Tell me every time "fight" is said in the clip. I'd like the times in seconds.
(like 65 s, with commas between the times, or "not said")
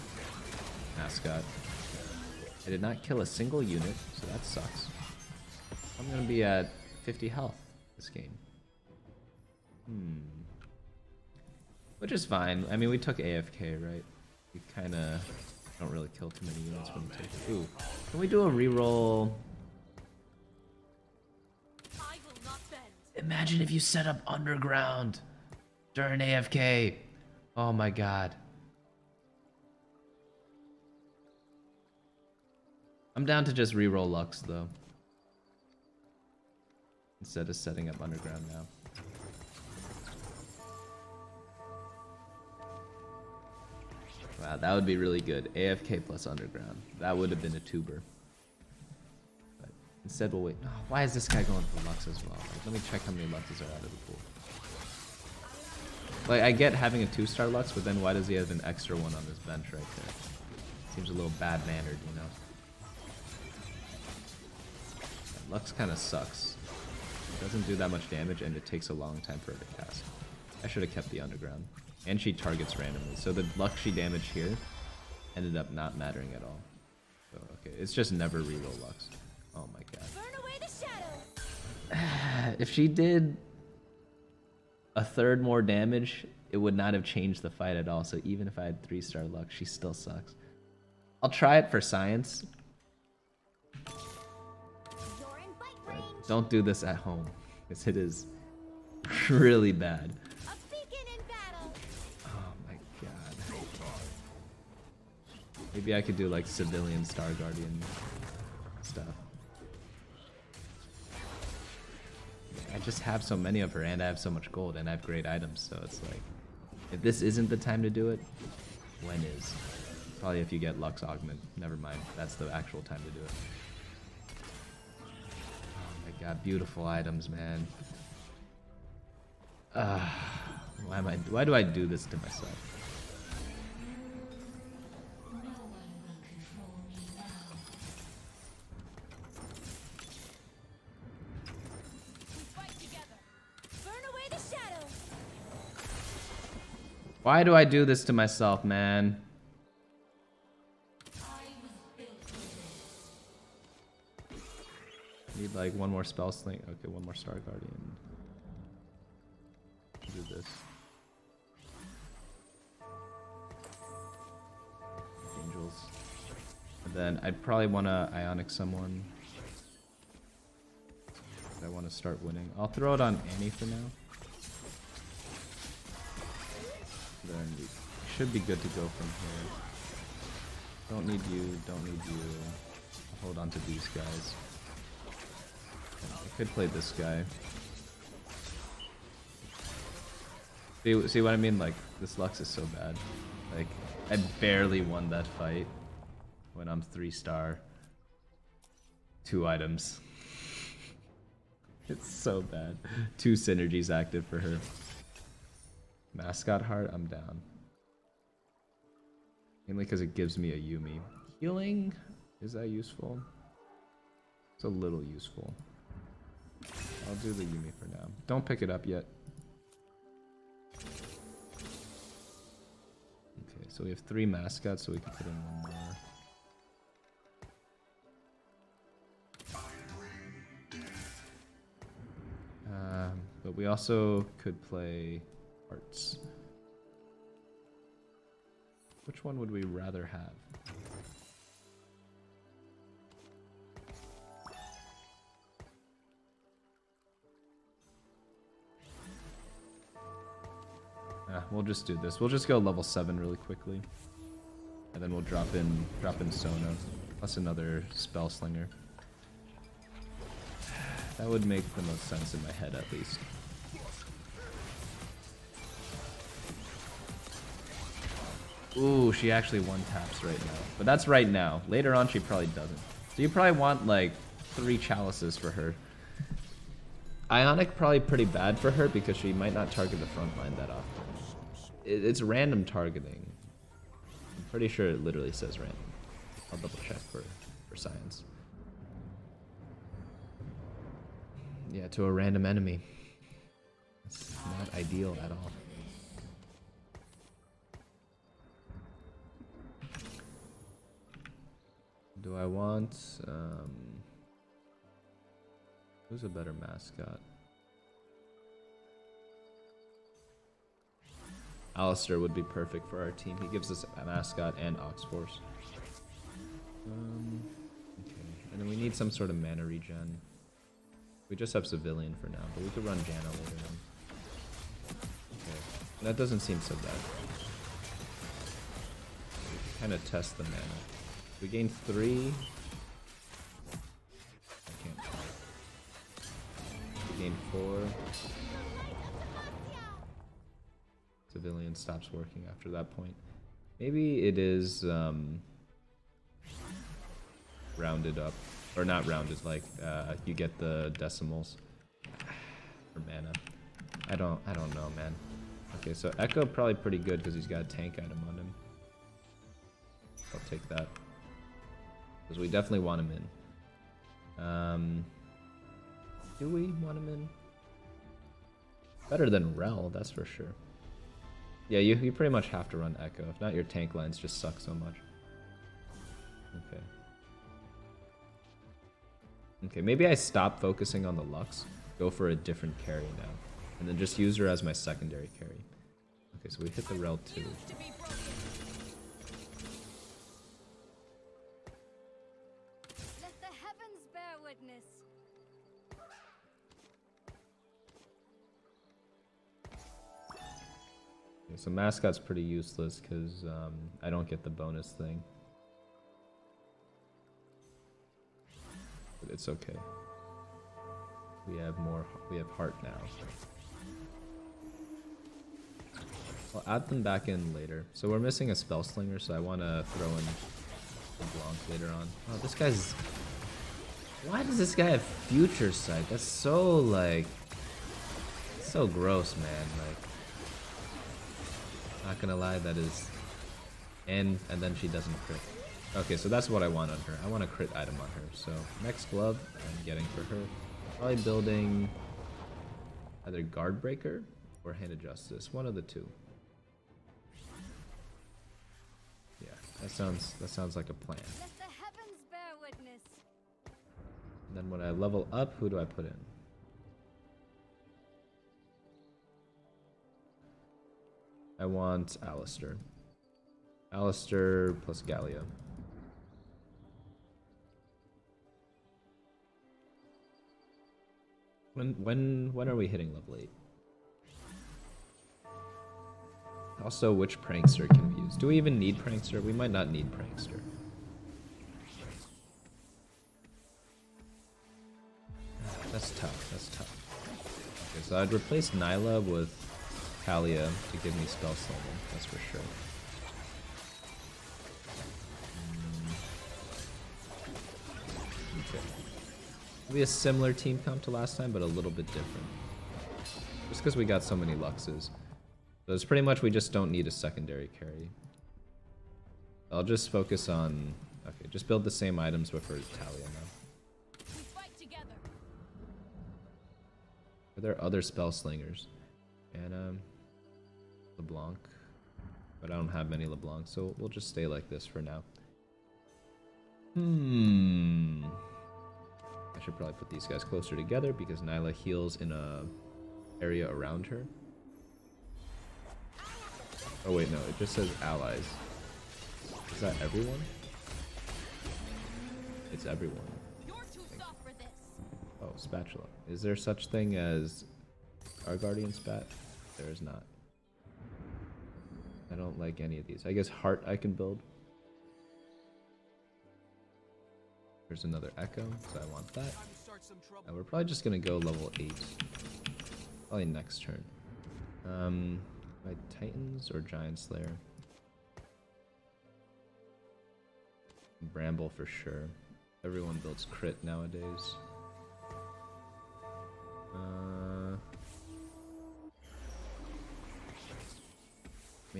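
87 s, 195 s.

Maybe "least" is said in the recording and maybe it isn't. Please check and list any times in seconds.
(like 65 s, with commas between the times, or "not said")
262 s.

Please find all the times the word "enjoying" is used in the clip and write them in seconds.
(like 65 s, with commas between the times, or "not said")
not said.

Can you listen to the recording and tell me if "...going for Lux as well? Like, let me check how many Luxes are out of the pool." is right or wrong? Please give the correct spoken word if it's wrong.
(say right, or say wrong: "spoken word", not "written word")
right.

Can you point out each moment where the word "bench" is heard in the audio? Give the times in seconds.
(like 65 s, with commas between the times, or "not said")
59 s.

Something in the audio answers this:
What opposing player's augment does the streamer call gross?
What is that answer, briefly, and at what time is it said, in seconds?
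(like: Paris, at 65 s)
Future Sight, at 425 s.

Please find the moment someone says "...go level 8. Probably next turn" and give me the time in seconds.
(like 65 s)
561 s.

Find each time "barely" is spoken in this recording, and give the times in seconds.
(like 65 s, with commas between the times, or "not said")
194 s.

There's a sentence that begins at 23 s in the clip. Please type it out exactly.
Imagine if you set up underground during AFK.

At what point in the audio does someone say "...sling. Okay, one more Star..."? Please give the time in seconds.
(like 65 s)
156 s.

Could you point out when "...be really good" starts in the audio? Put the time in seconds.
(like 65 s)
44 s.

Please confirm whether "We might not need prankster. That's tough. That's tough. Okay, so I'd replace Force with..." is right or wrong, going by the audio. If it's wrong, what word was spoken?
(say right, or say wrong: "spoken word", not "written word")
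wrong: "Nilah", not "Force".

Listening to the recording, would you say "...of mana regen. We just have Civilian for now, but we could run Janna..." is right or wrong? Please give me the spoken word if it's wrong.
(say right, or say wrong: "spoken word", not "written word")
right.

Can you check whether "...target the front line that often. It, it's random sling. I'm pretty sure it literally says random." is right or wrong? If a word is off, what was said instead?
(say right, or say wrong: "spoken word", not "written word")
wrong: "targeting", not "sling".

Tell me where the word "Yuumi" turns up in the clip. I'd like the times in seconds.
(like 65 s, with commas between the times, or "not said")
210 s, 217 s.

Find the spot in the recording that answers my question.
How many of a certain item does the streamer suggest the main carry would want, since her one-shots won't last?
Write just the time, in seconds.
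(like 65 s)
274 s.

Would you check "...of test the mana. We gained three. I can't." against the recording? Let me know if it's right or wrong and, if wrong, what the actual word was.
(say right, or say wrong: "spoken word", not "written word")
right.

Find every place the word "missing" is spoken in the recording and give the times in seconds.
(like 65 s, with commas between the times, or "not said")
418 s.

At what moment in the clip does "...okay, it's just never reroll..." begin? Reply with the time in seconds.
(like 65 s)
77 s.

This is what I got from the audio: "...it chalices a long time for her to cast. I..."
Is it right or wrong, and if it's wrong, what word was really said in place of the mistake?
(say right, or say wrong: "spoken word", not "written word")
wrong: "takes", not "chalices".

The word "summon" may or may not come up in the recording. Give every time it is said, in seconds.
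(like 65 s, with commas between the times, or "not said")
491 s.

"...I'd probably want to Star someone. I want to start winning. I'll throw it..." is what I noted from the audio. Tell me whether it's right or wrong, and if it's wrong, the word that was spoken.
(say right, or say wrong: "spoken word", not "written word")
wrong: "Ionic", not "Star".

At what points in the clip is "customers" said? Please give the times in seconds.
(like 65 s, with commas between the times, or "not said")
not said.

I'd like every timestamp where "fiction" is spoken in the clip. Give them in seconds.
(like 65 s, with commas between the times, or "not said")
not said.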